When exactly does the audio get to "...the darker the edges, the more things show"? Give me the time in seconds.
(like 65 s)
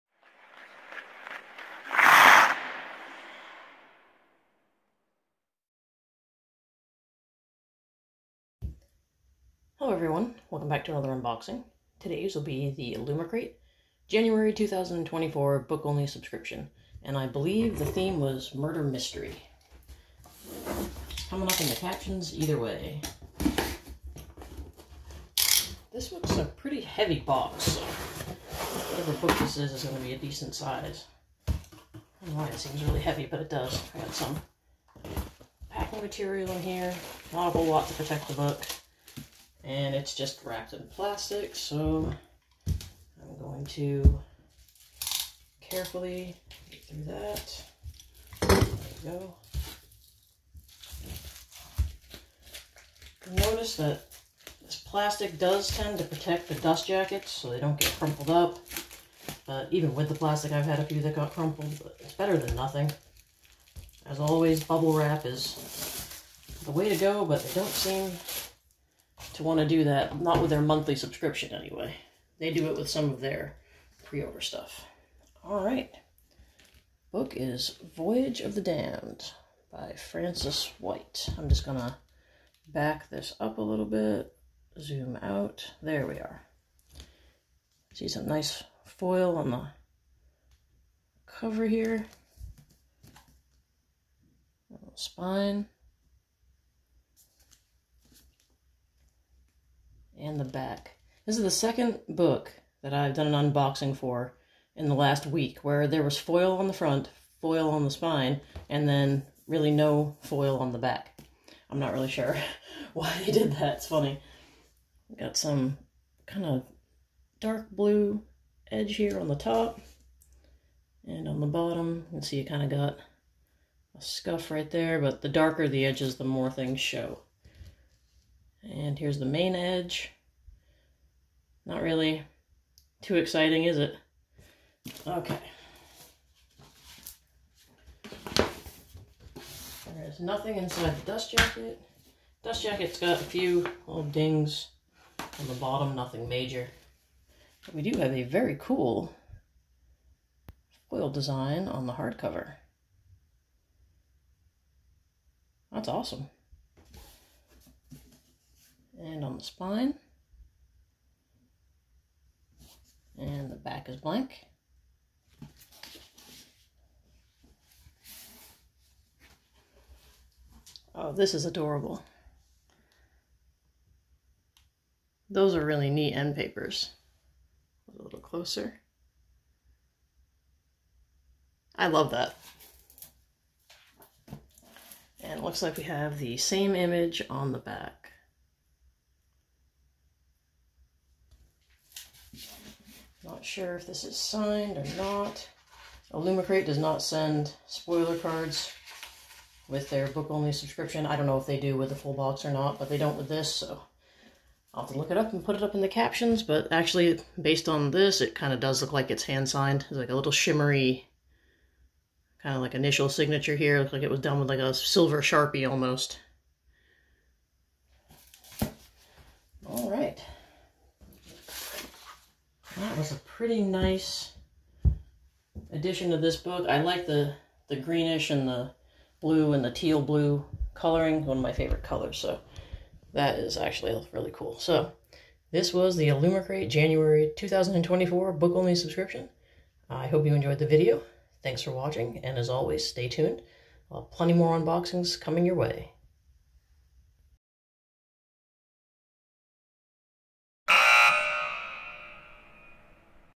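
125 s.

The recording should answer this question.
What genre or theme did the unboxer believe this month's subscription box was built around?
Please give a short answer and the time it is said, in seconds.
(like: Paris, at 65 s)
murder mystery, at 18 s.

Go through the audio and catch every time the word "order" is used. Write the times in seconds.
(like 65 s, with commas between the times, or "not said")
74 s.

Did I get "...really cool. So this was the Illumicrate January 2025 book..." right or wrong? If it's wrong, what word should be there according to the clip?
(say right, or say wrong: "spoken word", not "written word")
wrong: "2024", not "2025".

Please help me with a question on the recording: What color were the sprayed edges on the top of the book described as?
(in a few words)
dark blue.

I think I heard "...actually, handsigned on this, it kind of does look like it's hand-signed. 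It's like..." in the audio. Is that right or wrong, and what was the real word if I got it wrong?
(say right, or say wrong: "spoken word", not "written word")
wrong: "based", not "handsigned".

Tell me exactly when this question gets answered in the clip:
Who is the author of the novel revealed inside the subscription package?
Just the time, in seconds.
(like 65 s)
79 s.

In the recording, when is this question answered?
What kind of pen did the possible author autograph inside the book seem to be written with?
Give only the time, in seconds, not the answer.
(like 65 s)
214 s.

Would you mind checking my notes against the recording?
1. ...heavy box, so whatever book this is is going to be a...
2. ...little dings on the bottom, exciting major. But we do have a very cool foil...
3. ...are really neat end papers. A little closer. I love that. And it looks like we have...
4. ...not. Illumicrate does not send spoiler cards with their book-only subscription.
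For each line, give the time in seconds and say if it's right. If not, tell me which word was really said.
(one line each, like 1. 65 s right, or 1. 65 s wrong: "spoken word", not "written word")
1. 26 s right
2. 143 s wrong: "nothing", not "exciting"
3. 175 s right
4. 194 s right.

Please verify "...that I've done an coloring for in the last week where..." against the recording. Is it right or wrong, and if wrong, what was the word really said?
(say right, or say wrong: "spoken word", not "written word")
wrong: "unboxing", not "coloring".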